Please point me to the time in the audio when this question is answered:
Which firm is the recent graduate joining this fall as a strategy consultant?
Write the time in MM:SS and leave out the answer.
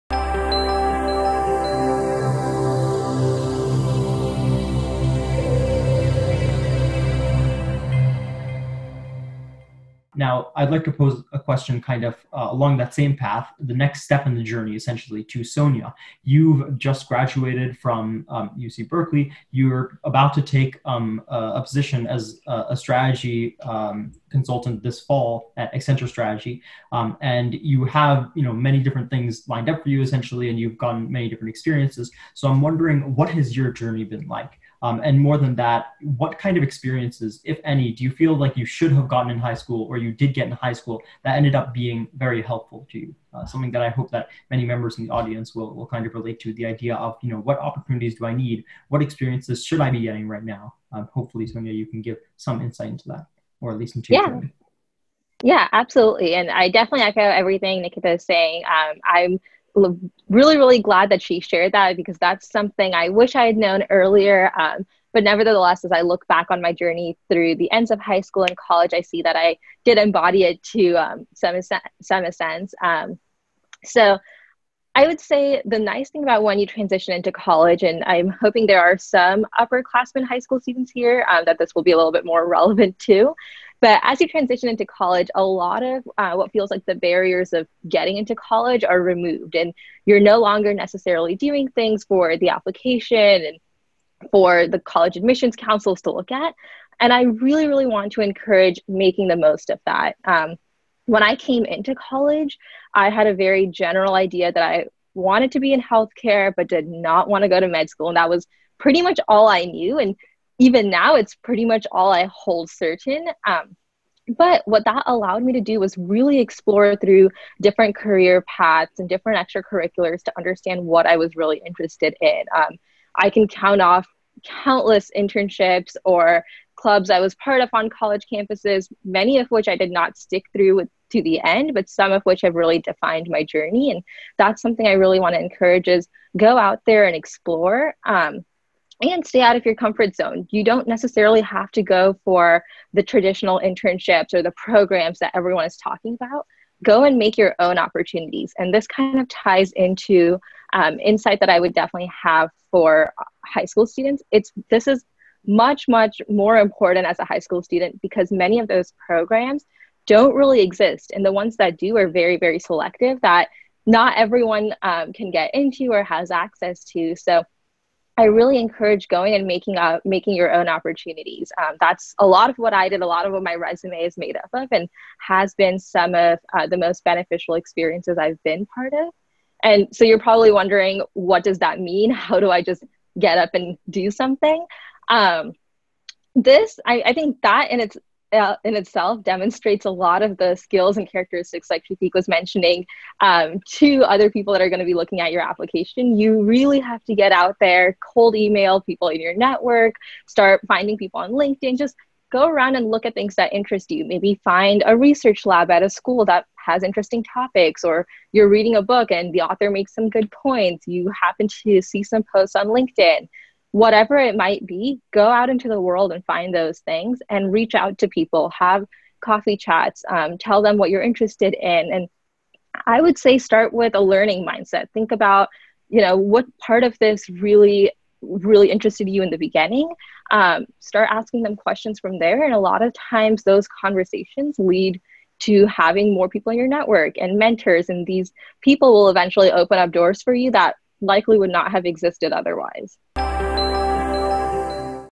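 00:25.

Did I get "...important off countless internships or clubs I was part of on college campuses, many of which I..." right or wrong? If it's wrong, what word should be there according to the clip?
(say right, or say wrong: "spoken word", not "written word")
wrong: "count", not "important".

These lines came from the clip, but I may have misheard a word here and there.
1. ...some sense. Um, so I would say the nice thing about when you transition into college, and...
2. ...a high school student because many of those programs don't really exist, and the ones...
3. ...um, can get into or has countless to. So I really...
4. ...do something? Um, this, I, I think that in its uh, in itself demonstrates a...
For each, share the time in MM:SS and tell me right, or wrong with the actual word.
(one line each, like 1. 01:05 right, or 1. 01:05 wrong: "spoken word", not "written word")
1. 01:12 right
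2. 02:37 right
3. 02:44 wrong: "access", not "countless"
4. 03:03 right.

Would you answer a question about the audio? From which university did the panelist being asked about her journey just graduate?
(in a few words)
UC Berkeley.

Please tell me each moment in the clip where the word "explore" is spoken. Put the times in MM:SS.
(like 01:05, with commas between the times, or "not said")
01:56, 02:17.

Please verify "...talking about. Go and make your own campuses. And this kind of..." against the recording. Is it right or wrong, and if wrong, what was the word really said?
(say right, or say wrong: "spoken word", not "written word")
wrong: "opportunities", not "campuses".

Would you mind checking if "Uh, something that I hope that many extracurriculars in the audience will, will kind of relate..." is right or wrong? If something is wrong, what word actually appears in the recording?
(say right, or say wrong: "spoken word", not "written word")
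wrong: "members", not "extracurriculars".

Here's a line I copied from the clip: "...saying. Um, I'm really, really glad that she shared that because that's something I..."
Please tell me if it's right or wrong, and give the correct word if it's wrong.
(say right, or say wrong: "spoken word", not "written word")
right.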